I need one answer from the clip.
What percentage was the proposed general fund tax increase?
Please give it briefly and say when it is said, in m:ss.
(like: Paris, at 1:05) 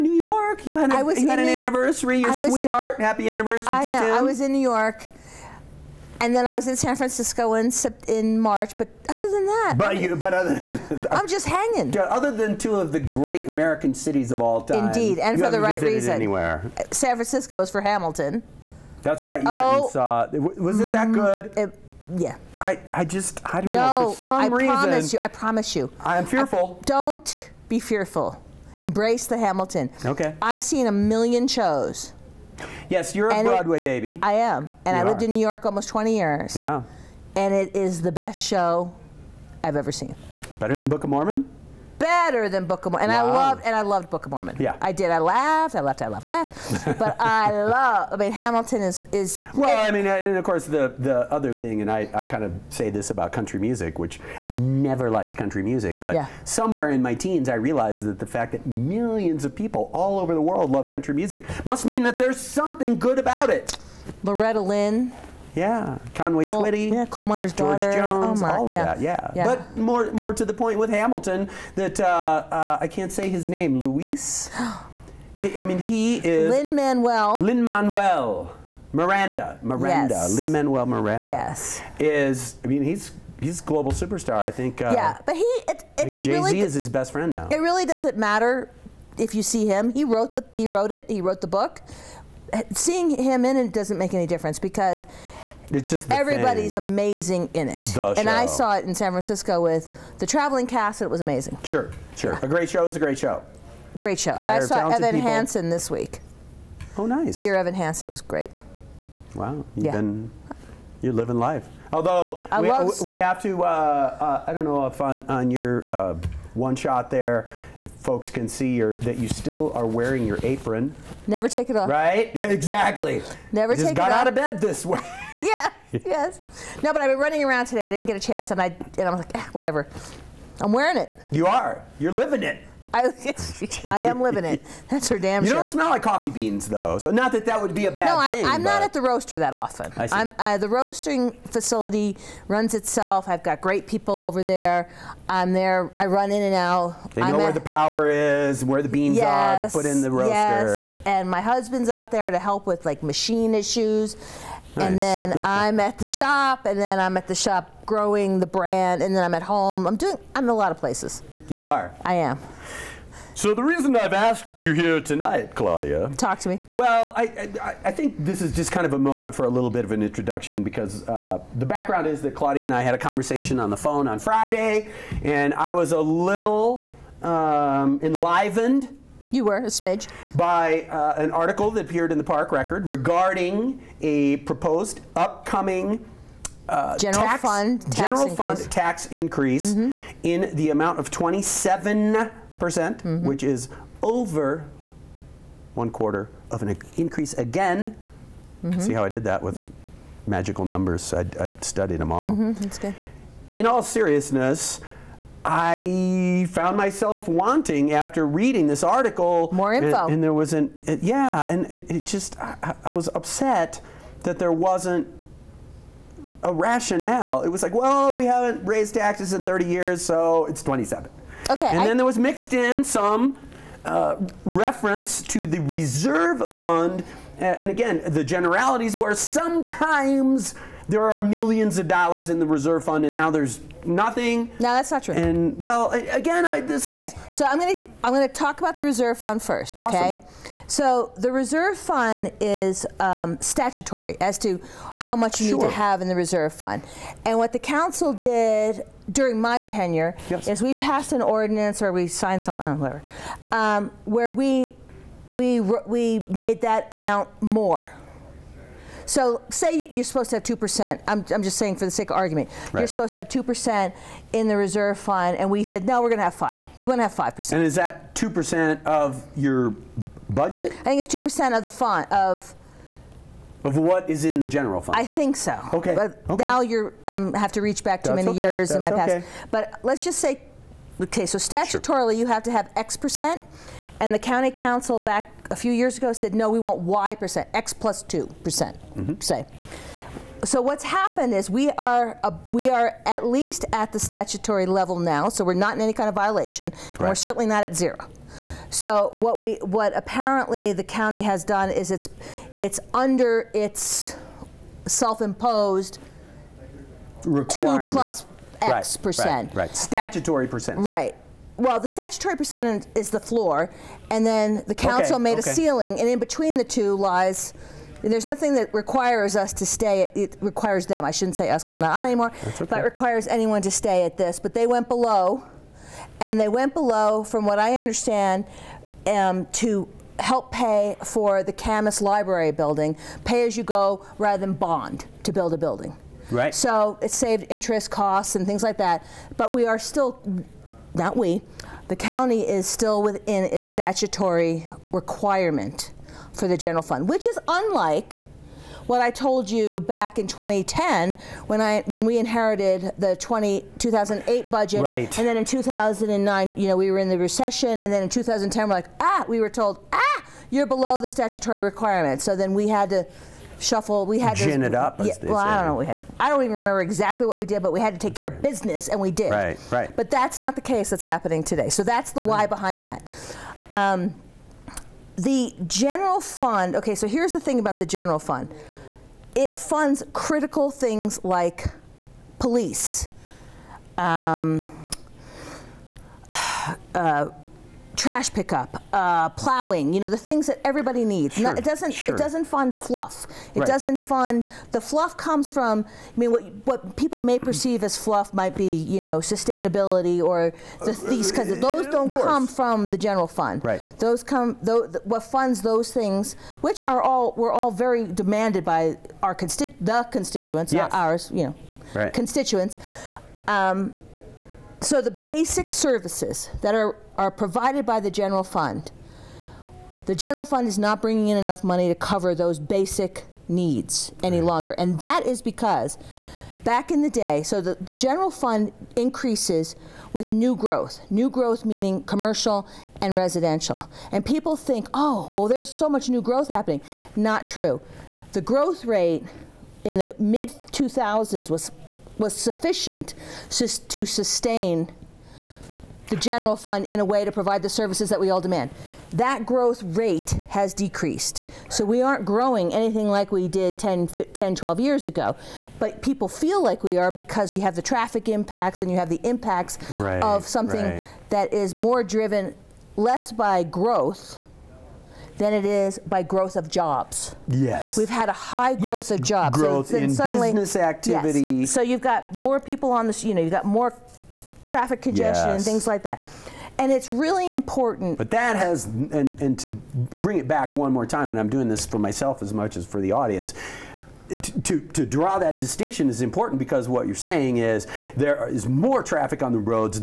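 27%, at 3:11.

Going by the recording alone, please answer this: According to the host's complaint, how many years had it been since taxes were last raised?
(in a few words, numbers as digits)
30.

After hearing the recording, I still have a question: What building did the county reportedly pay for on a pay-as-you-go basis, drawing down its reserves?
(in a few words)
Kamas Library.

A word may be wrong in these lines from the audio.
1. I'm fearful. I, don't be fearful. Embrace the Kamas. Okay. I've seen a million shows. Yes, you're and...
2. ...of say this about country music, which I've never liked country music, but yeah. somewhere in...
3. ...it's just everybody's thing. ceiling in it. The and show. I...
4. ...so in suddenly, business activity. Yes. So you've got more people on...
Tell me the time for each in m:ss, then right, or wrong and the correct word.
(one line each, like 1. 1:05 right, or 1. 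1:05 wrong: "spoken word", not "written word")
1. 0:25 wrong: "Hamilton", not "Kamas"
2. 0:52 right
3. 1:35 wrong: "amazing", not "ceiling"
4. 7:49 right.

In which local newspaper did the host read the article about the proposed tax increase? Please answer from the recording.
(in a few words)
Park Record.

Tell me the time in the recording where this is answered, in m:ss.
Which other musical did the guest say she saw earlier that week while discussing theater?
1:47.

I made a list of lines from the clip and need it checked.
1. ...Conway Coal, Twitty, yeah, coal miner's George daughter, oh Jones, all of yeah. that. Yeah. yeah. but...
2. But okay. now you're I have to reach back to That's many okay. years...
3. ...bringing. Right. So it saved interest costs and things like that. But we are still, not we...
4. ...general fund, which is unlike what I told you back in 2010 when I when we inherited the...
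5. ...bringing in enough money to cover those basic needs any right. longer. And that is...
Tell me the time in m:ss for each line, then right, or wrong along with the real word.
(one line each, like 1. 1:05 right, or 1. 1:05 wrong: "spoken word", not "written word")
1. 1:06 right
2. 4:35 right
3. 5:35 wrong: "building", not "bringing"
4. 5:46 right
5. 7:01 right.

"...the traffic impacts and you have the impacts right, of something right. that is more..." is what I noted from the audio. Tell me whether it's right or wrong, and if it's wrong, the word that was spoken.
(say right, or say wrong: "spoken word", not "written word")
right.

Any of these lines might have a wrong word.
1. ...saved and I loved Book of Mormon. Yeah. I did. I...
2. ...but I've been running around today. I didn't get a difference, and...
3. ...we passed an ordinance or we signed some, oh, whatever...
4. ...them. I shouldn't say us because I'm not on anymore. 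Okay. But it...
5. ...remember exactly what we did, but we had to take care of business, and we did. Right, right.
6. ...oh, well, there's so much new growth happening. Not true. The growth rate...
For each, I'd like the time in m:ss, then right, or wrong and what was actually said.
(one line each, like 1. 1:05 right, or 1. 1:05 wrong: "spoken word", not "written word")
1. 0:43 wrong: "loved", not "saved"
2. 2:06 wrong: "chance", not "difference"
3. 4:10 right
4. 5:20 right
5. 6:06 right
6. 7:14 right.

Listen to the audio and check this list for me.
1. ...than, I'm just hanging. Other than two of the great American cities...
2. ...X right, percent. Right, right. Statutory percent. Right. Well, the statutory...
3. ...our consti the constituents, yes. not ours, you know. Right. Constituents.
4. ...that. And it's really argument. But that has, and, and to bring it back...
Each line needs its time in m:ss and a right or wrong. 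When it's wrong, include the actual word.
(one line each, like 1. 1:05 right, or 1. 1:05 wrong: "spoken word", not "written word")
1. 0:10 right
2. 5:08 right
3. 6:49 right
4. 7:56 wrong: "important", not "argument".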